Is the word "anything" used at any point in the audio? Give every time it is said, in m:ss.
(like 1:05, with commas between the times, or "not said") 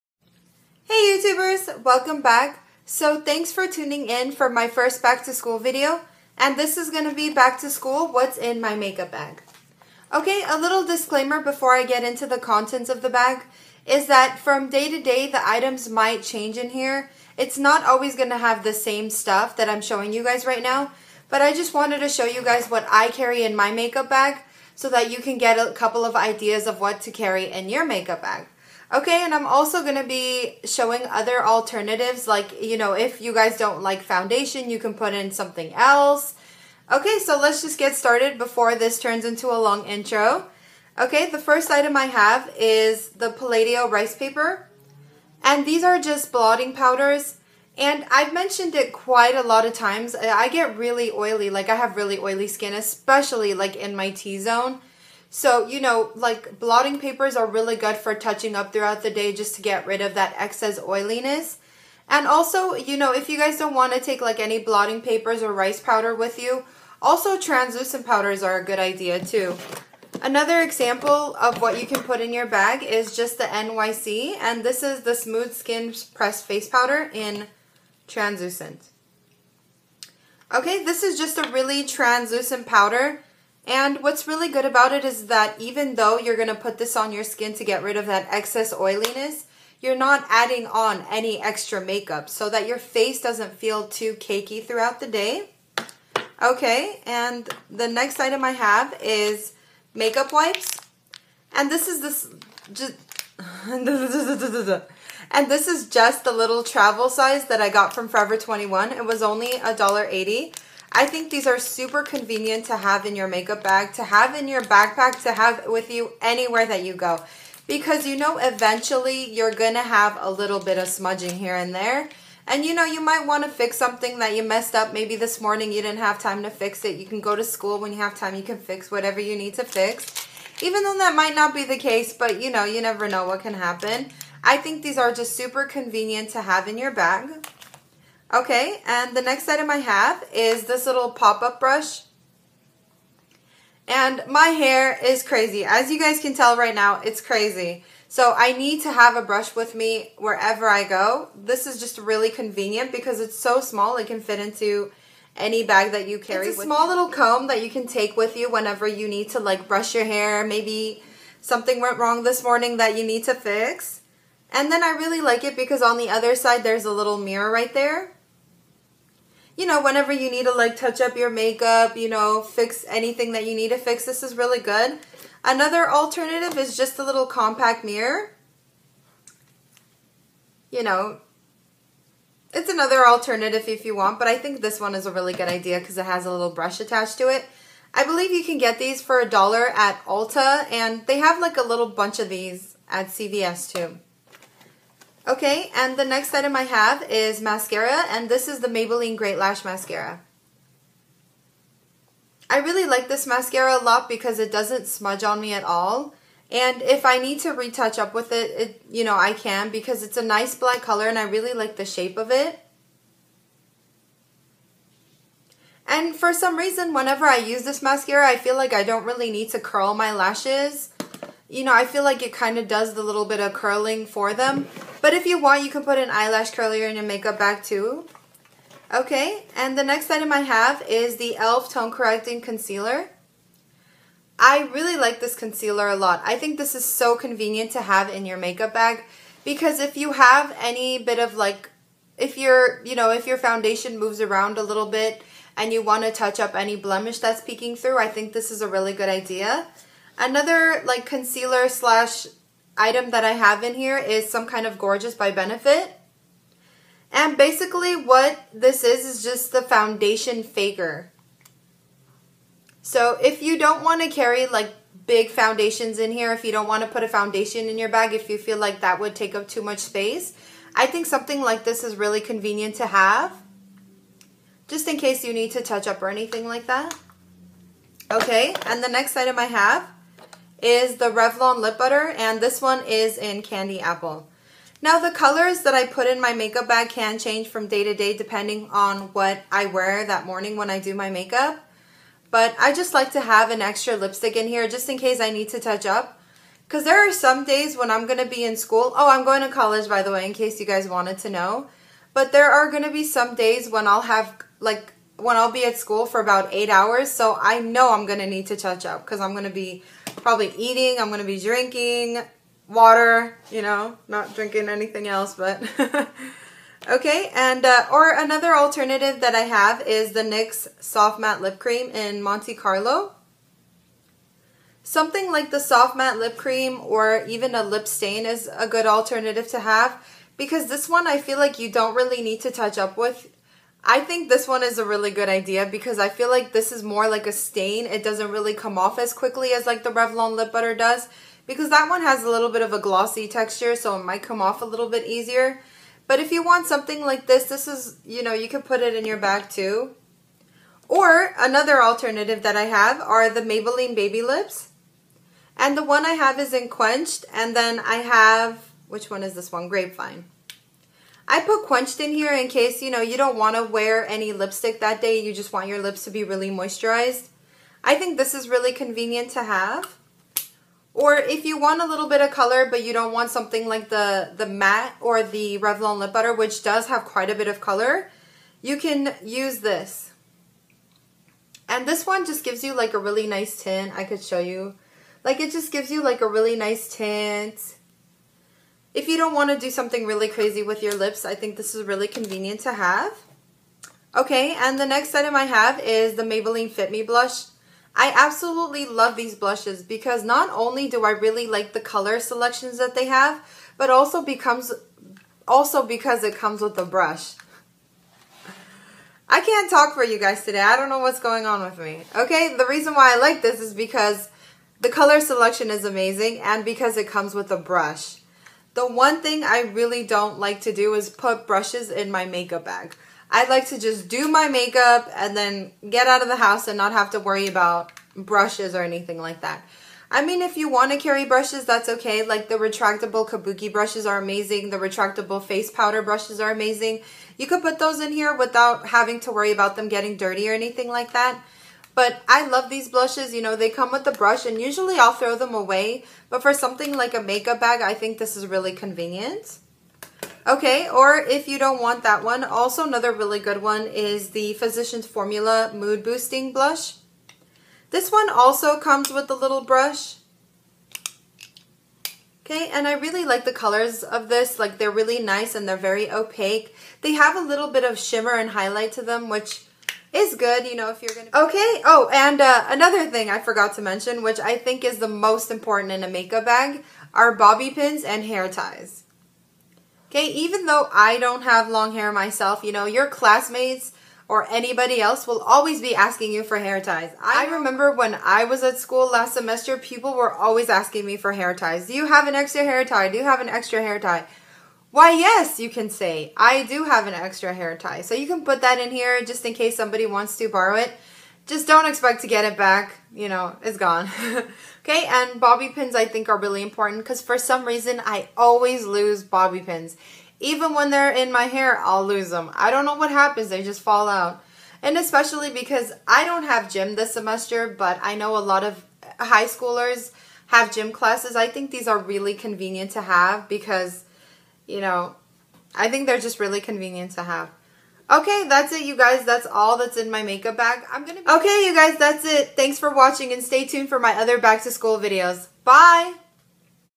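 2:52, 4:36, 5:14, 7:08, 7:20.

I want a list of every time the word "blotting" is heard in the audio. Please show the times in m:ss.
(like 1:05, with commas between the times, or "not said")
0:46, 0:56, 1:04.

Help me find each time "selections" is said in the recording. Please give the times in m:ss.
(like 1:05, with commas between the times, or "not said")
6:42, 6:55.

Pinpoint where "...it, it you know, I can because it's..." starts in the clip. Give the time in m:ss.
3:28.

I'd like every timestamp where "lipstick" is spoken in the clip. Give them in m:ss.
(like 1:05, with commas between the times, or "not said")
4:53, 6:04.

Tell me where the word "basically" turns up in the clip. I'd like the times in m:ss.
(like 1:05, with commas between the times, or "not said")
4:17.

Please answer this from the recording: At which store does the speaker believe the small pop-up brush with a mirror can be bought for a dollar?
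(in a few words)
Ulta.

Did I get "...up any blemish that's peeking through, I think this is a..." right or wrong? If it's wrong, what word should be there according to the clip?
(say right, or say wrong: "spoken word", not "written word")
right.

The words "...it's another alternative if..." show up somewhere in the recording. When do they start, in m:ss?
3:02.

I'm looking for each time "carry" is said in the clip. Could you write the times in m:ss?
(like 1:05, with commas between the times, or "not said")
0:23, 0:27, 2:36, 4:24, 7:10.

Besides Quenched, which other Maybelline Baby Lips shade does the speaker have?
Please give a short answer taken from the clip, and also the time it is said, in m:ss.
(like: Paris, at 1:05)
Grapevine, at 5:59.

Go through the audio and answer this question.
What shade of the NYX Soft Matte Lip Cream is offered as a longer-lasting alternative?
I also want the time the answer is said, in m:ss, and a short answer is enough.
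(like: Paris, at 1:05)
Monte Carlo, at 5:22.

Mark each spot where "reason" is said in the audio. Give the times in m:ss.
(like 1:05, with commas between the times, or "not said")
3:36, 6:52, 8:27.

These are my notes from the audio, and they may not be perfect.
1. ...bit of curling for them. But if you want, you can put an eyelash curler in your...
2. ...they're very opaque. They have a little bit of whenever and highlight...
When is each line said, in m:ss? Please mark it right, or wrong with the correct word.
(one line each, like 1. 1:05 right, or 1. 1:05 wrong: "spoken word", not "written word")
1. 3:43 right
2. 7:45 wrong: "shimmer", not "whenever".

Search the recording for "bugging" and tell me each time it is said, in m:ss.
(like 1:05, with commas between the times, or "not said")
not said.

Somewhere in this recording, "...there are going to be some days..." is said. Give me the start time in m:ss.
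5:02.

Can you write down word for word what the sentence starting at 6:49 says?
I can't talk for you guys today.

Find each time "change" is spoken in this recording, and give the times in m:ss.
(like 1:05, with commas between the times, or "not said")
0:16, 4:47.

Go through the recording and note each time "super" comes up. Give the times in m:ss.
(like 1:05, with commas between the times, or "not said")
1:51, 2:15.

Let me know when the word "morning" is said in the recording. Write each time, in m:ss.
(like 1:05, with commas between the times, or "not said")
2:05, 2:42, 4:50.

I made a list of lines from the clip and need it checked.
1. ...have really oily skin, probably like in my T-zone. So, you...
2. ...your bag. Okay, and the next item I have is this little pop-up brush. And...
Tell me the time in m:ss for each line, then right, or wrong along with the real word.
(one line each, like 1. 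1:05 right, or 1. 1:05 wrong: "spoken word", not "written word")
1. 0:51 wrong: "especially", not "probably"
2. 2:16 right.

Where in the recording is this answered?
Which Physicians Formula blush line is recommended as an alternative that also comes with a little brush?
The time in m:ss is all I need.
7:35.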